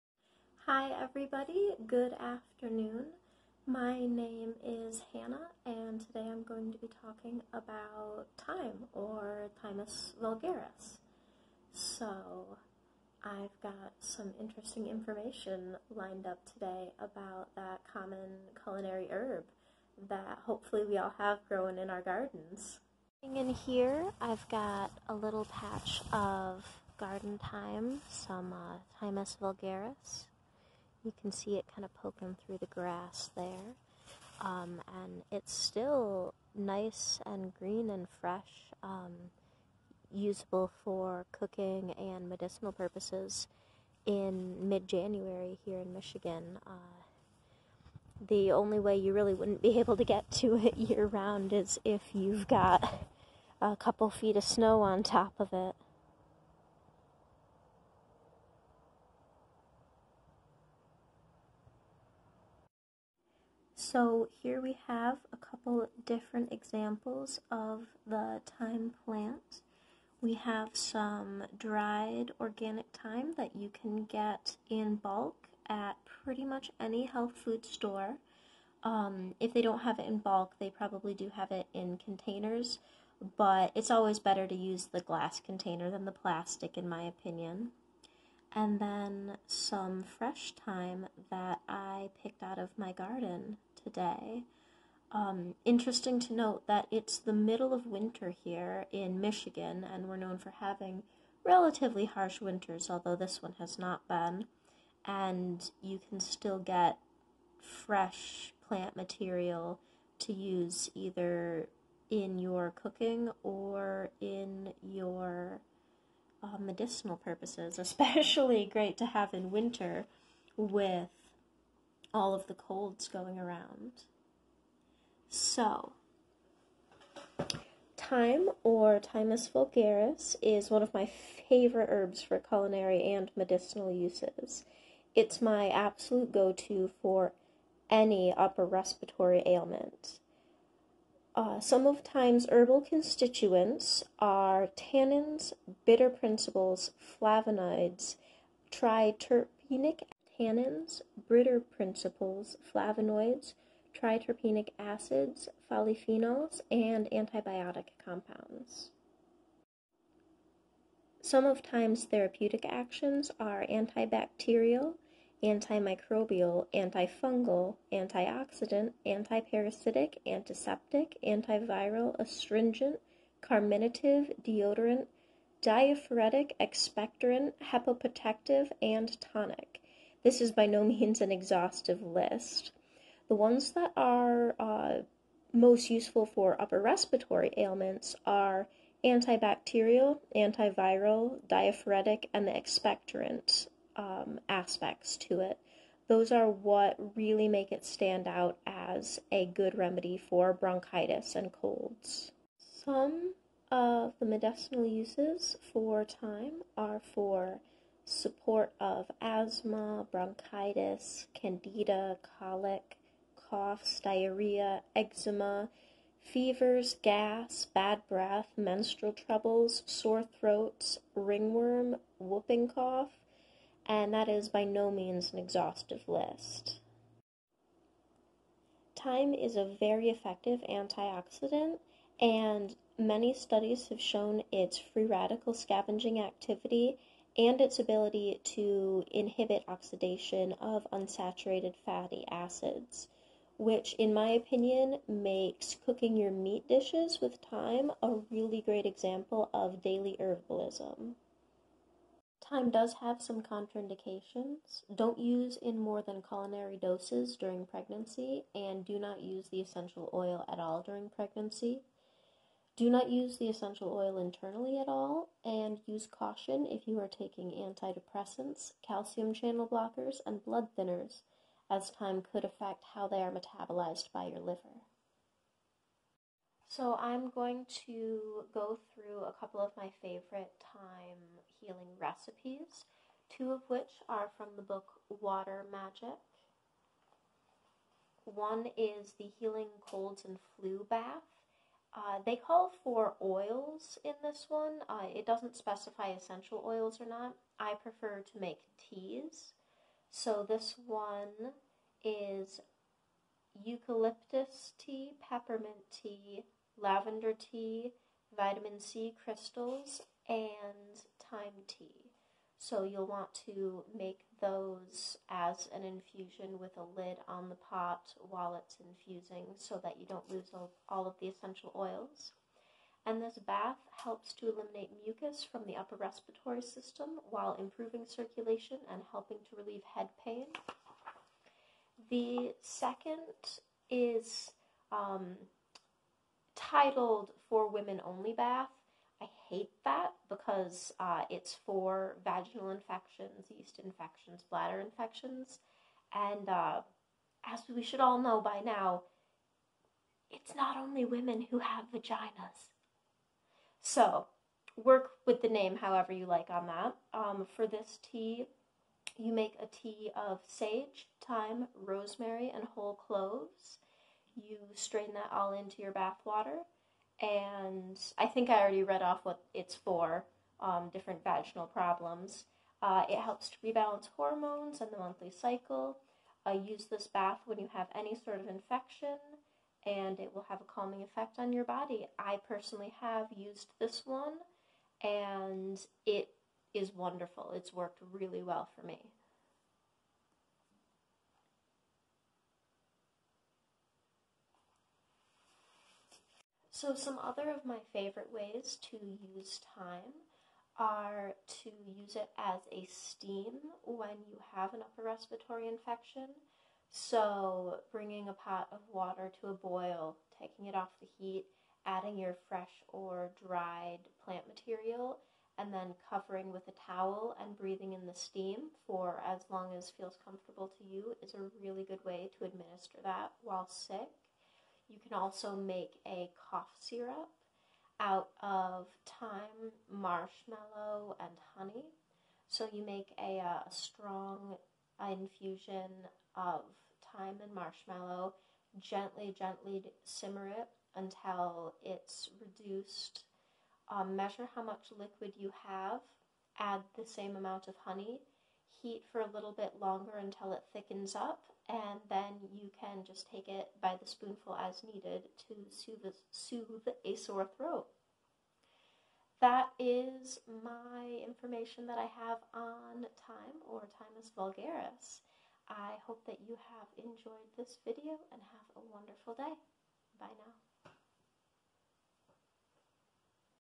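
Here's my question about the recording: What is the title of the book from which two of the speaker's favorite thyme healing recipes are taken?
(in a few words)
Water Magic.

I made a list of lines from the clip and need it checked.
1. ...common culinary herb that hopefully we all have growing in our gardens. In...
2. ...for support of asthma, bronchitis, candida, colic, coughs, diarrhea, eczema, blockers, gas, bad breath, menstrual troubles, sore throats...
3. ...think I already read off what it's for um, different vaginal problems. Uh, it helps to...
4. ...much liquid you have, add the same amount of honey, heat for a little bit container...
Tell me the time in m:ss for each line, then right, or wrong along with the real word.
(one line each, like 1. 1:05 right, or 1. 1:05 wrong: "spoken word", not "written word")
1. 0:17 right
2. 3:27 wrong: "fevers", not "blockers"
3. 6:08 right
4. 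7:24 wrong: "longer", not "container".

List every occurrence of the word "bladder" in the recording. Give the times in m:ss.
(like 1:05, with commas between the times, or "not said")
5:44.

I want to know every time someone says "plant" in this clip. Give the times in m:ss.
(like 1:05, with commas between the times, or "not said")
1:09, 1:48, 6:54.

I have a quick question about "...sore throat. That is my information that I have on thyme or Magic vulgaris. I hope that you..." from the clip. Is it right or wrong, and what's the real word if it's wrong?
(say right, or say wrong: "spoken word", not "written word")
wrong: "Thymus", not "Magic".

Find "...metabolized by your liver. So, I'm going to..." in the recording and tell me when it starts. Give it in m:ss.
4:33.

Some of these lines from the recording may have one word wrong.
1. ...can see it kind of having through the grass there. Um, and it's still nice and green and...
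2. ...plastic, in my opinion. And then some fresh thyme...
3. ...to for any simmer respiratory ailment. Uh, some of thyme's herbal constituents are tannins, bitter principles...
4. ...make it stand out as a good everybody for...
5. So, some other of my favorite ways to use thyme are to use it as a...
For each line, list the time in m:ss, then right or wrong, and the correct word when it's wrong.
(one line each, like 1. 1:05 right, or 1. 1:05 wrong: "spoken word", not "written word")
1. 0:31 wrong: "poking", not "having"
2. 1:26 right
3. 2:16 wrong: "upper", not "simmer"
4. 3:17 wrong: "remedy", not "everybody"
5. 6:36 right.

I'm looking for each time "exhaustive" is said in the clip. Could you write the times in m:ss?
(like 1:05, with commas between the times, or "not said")
3:01, 3:45.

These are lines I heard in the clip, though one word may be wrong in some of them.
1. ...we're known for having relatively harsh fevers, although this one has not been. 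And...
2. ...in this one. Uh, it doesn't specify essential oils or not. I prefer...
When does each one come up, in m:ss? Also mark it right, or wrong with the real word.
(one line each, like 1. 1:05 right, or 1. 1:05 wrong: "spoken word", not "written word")
1. 1:40 wrong: "winters", not "fevers"
2. 4:54 right.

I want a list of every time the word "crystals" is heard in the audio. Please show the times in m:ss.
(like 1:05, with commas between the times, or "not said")
5:09.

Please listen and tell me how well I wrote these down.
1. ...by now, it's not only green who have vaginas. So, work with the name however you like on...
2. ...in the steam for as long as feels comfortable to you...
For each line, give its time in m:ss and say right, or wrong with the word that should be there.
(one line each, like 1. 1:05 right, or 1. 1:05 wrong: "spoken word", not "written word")
1. 5:48 wrong: "women", not "green"
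2. 6:57 right.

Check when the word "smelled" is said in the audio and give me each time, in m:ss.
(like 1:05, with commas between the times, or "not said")
not said.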